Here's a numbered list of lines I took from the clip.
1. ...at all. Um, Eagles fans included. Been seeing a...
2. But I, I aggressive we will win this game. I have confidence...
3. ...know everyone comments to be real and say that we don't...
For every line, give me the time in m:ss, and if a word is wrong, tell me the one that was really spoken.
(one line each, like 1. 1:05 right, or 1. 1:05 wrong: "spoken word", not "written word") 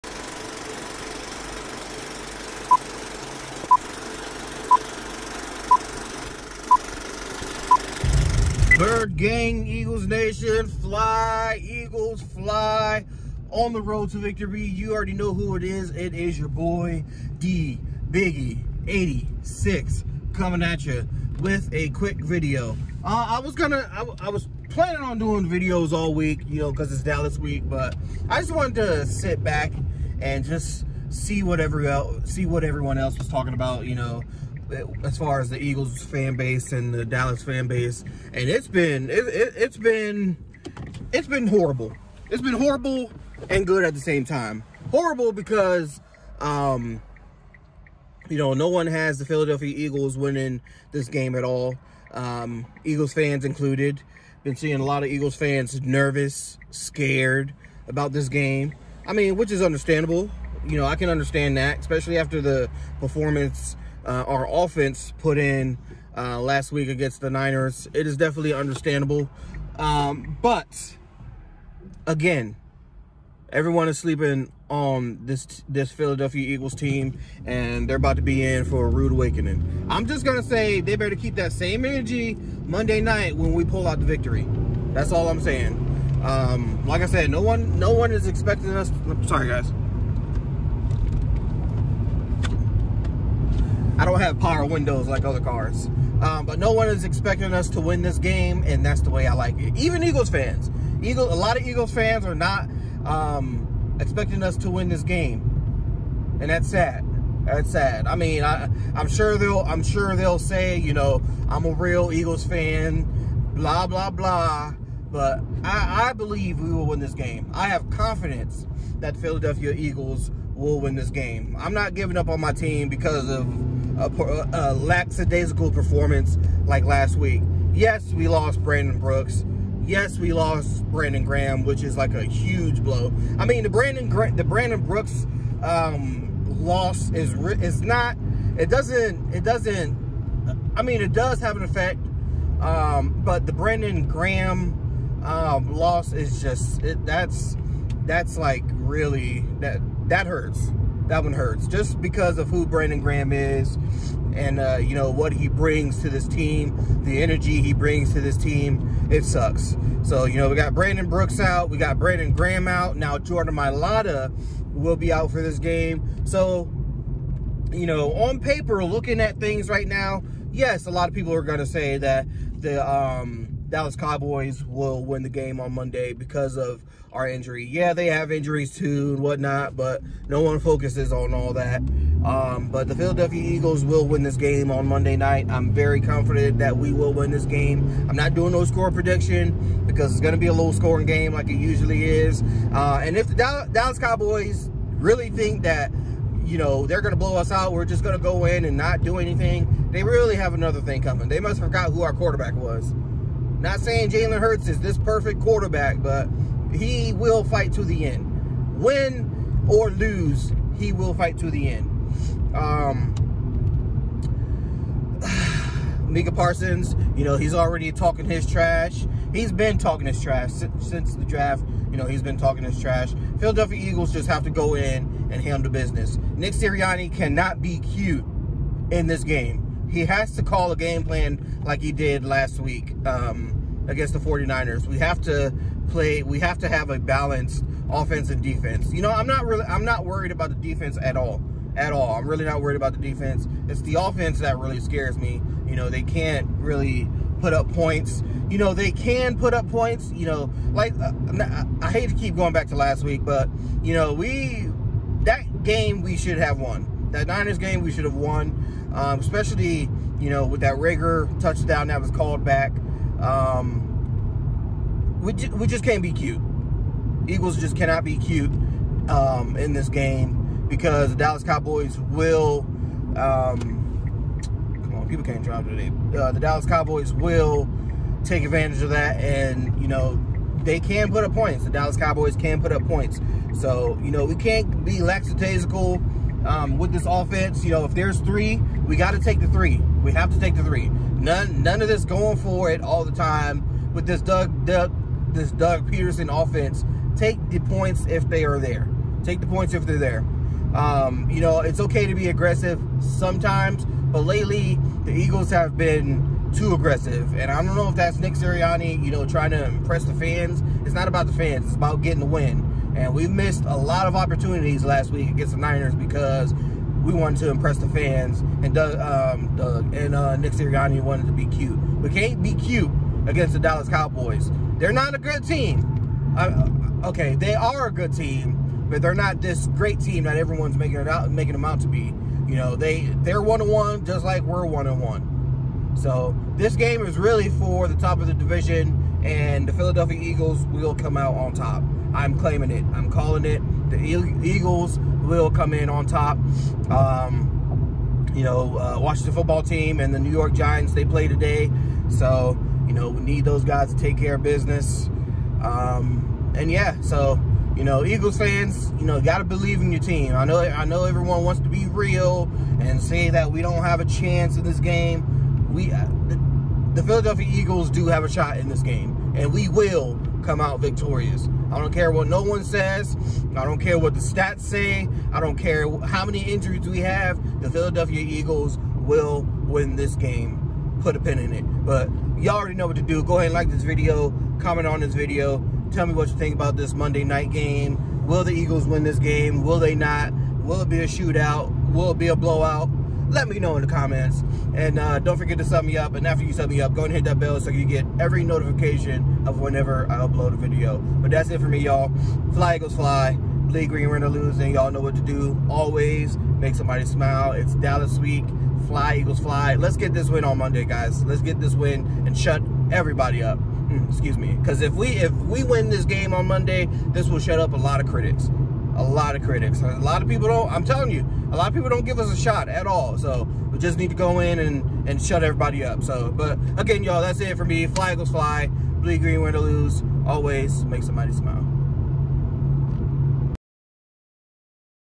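1. 0:51 right
2. 1:55 wrong: "believe", not "aggressive"
3. 6:00 wrong: "wants", not "comments".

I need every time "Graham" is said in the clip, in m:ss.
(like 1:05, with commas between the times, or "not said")
2:11, 2:24, 2:33, 2:42.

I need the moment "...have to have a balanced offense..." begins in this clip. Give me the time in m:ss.
3:56.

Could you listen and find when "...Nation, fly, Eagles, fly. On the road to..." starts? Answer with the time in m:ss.
0:10.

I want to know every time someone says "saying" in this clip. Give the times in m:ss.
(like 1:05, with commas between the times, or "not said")
1:25, 3:23.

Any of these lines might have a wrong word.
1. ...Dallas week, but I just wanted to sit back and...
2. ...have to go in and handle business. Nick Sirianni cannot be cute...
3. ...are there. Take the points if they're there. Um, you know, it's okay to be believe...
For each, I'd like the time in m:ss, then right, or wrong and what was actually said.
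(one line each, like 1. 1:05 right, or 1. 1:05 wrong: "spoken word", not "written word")
1. 0:27 right
2. 3:44 right
3. 4:58 wrong: "aggressive", not "believe".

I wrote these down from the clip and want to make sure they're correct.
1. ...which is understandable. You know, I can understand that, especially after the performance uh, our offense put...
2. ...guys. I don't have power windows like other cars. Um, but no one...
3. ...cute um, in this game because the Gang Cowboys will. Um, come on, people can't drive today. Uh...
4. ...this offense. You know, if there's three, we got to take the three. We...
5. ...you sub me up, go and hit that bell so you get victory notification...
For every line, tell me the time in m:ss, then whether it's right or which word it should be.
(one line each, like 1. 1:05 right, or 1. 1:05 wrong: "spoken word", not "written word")
1. 0:59 right
2. 1:29 right
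3. 4:28 wrong: "Dallas", not "Gang"
4. 4:46 right
5. 6:36 wrong: "every", not "victory".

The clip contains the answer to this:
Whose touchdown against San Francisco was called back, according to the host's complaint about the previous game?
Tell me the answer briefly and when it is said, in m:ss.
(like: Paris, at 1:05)
Reagor, at 4:20.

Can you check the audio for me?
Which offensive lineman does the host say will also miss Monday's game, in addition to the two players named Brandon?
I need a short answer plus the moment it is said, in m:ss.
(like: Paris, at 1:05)
Jordan Mailata, at 2:43.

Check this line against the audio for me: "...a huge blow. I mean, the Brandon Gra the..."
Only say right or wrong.
right.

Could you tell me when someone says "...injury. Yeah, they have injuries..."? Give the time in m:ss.
2:57.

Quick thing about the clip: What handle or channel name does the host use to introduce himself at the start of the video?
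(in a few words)
D Biggie 86.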